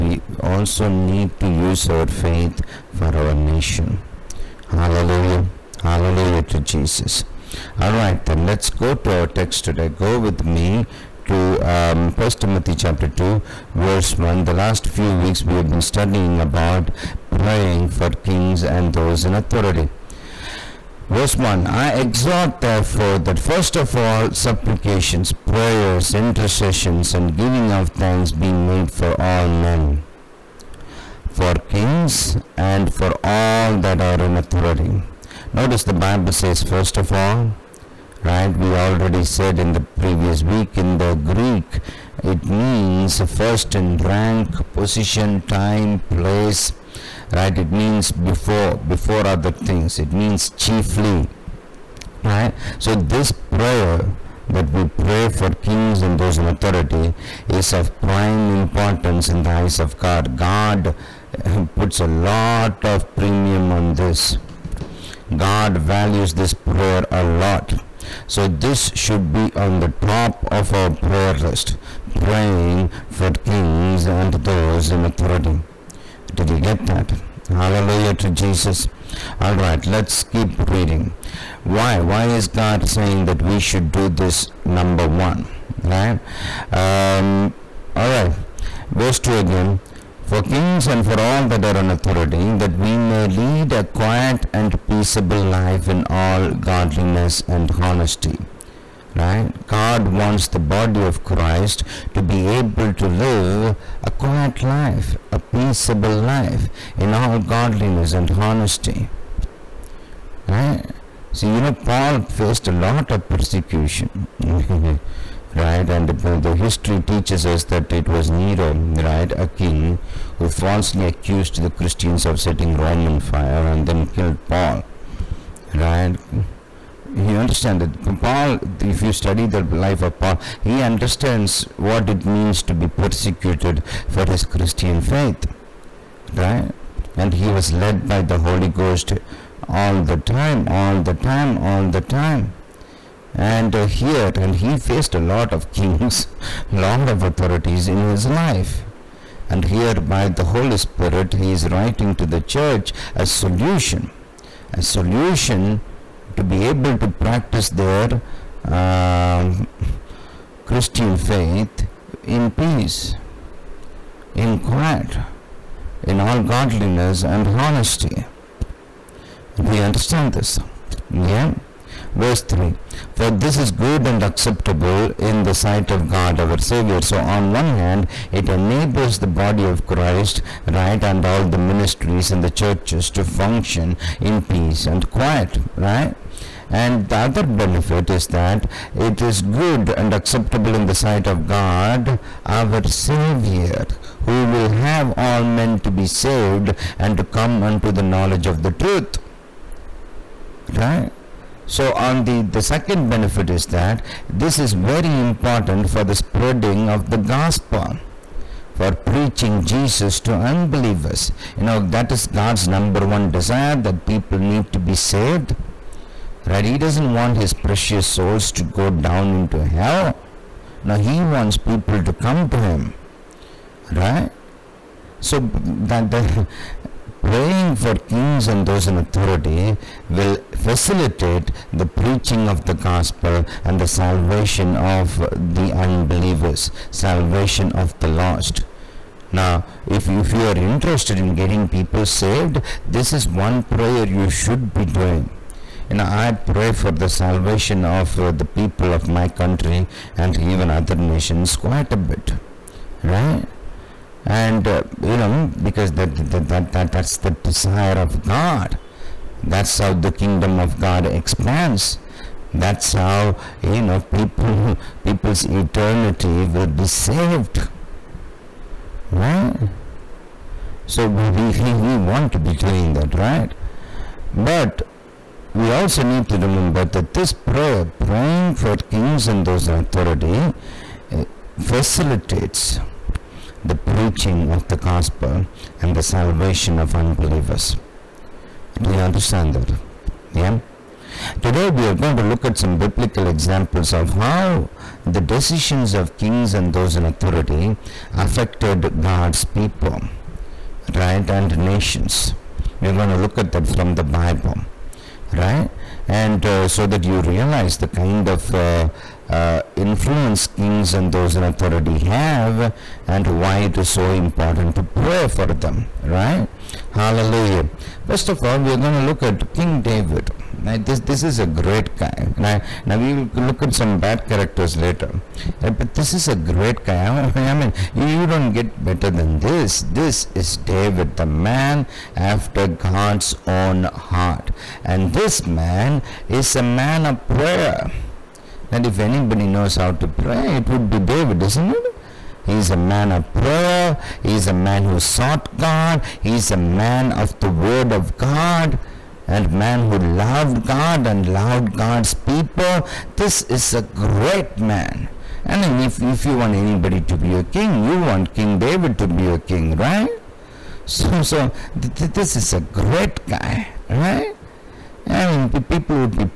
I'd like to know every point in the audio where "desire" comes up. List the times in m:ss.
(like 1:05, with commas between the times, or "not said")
3:33, 4:17.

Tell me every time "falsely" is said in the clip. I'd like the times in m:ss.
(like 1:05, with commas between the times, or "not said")
2:00.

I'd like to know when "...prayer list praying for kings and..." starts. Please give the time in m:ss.
1:10.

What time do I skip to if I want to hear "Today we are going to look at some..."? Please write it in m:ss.
4:51.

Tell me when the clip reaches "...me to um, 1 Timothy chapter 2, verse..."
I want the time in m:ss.
0:10.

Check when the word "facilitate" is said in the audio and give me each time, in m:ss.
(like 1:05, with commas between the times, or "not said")
3:50, 4:41.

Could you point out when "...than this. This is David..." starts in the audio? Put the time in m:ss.
5:29.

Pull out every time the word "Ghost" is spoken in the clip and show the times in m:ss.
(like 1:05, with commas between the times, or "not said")
2:18.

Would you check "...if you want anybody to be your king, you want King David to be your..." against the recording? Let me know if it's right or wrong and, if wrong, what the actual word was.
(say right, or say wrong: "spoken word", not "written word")
right.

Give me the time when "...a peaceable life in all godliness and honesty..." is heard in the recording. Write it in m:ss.
1:45.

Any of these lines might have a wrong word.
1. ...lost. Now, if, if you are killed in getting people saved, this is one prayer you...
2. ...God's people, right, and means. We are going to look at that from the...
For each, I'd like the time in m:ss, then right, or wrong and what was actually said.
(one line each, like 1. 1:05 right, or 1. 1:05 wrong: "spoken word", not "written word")
1. 3:58 wrong: "interested", not "killed"
2. 4:58 wrong: "nations", not "means".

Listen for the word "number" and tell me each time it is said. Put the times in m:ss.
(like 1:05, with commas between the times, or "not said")
1:24, 3:32.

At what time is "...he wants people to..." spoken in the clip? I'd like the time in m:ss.
3:40.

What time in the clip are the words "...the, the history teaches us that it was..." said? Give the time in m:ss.
1:56.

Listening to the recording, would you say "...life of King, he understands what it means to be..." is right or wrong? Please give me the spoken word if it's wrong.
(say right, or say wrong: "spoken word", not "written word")
wrong: "Paul", not "King".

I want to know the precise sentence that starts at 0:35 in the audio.
Notice the Bible says, first of all, right?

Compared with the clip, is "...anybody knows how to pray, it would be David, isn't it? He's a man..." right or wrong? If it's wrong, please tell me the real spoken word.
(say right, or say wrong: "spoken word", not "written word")
right.